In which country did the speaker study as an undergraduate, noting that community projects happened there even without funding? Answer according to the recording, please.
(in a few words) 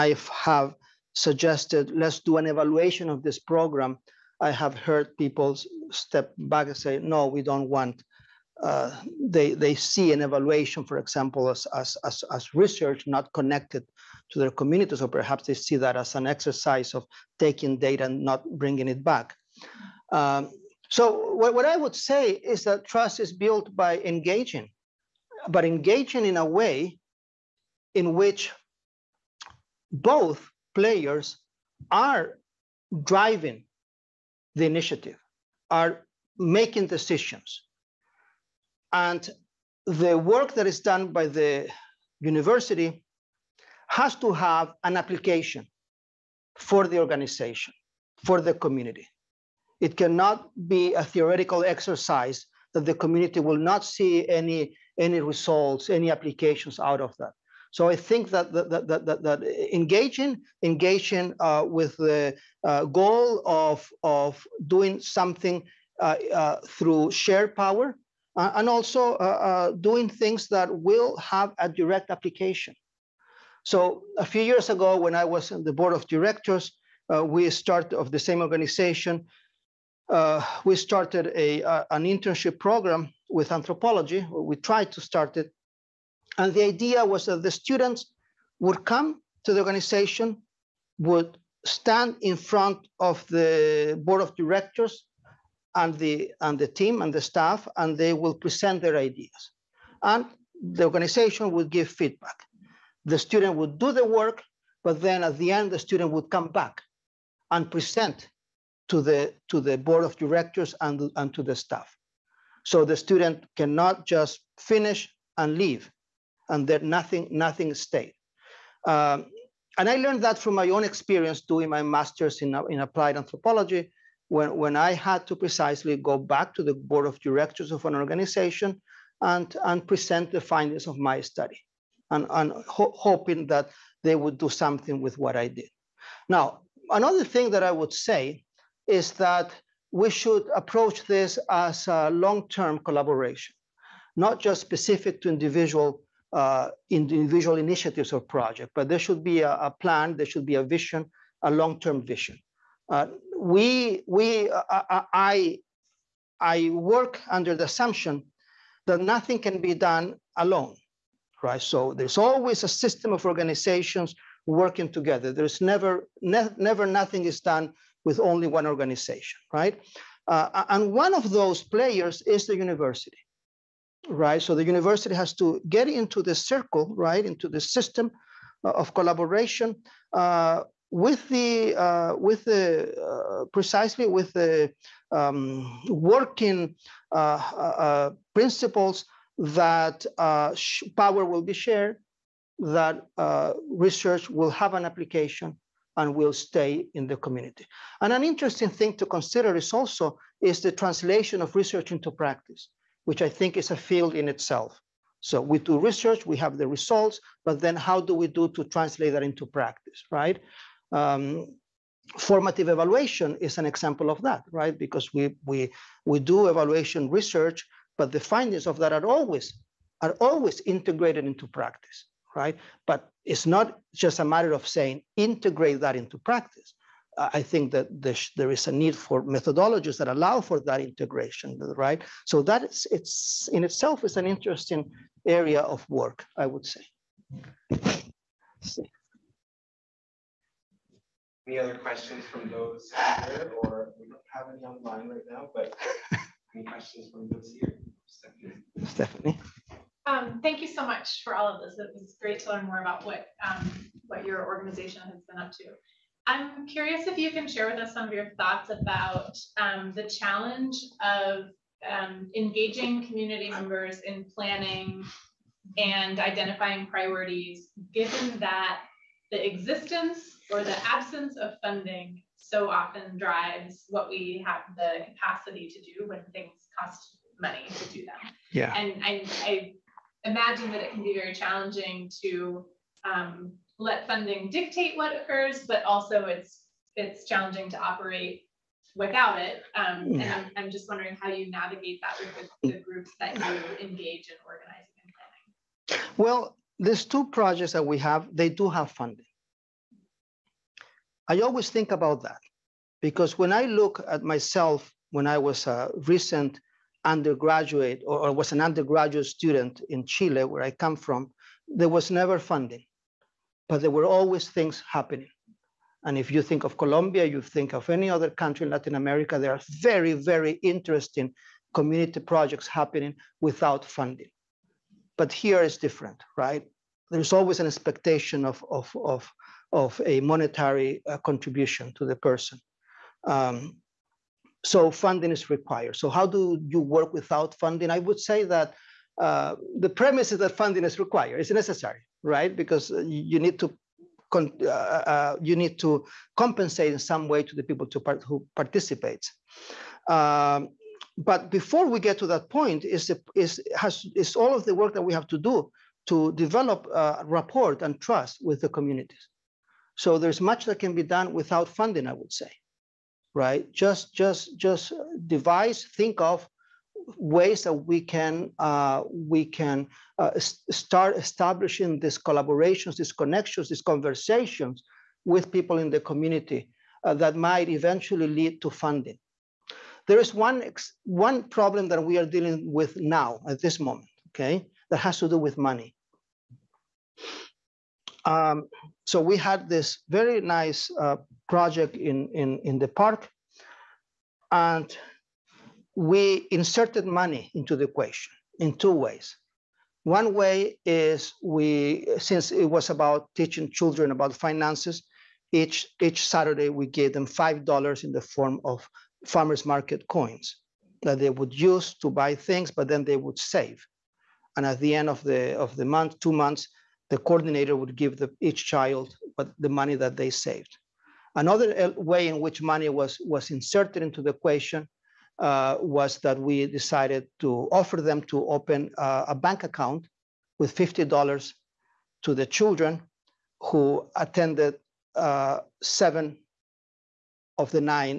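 Chile.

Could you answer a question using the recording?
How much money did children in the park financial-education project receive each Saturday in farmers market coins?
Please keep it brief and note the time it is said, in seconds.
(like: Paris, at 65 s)
$5, at 407 s.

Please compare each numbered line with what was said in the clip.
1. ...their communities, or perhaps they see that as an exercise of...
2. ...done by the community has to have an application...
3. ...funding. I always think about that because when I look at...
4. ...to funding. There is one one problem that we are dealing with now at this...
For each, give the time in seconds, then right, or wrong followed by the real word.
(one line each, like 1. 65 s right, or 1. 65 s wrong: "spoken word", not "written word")
1. 14 s right
2. 40 s wrong: "university", not "community"
3. 298 s right
4. 378 s right.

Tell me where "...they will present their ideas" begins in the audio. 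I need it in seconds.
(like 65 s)
97 s.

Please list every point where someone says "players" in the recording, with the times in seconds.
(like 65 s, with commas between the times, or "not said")
30 s, 171 s.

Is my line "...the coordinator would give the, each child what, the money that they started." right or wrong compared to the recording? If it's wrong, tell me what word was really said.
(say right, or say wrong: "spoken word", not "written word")
wrong: "saved", not "started".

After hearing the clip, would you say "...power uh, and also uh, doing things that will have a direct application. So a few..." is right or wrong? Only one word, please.
right.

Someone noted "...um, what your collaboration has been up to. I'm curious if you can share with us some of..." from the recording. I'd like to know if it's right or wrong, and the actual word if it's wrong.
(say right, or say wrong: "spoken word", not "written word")
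wrong: "organization", not "collaboration".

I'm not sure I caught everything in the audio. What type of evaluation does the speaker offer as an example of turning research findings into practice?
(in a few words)
Formative evaluation.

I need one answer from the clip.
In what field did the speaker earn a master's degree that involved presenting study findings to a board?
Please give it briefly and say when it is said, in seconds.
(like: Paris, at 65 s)
Applied anthropology, at 122 s.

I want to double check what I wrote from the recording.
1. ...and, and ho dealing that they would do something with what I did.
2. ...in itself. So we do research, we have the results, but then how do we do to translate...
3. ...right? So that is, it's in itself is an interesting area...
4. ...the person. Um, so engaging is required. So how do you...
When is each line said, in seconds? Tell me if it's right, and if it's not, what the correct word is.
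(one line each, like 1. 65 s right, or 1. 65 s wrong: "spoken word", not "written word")
1. 132 s wrong: "hoping", not "dealing"
2. 204 s right
3. 231 s right
4. 332 s wrong: "funding", not "engaging".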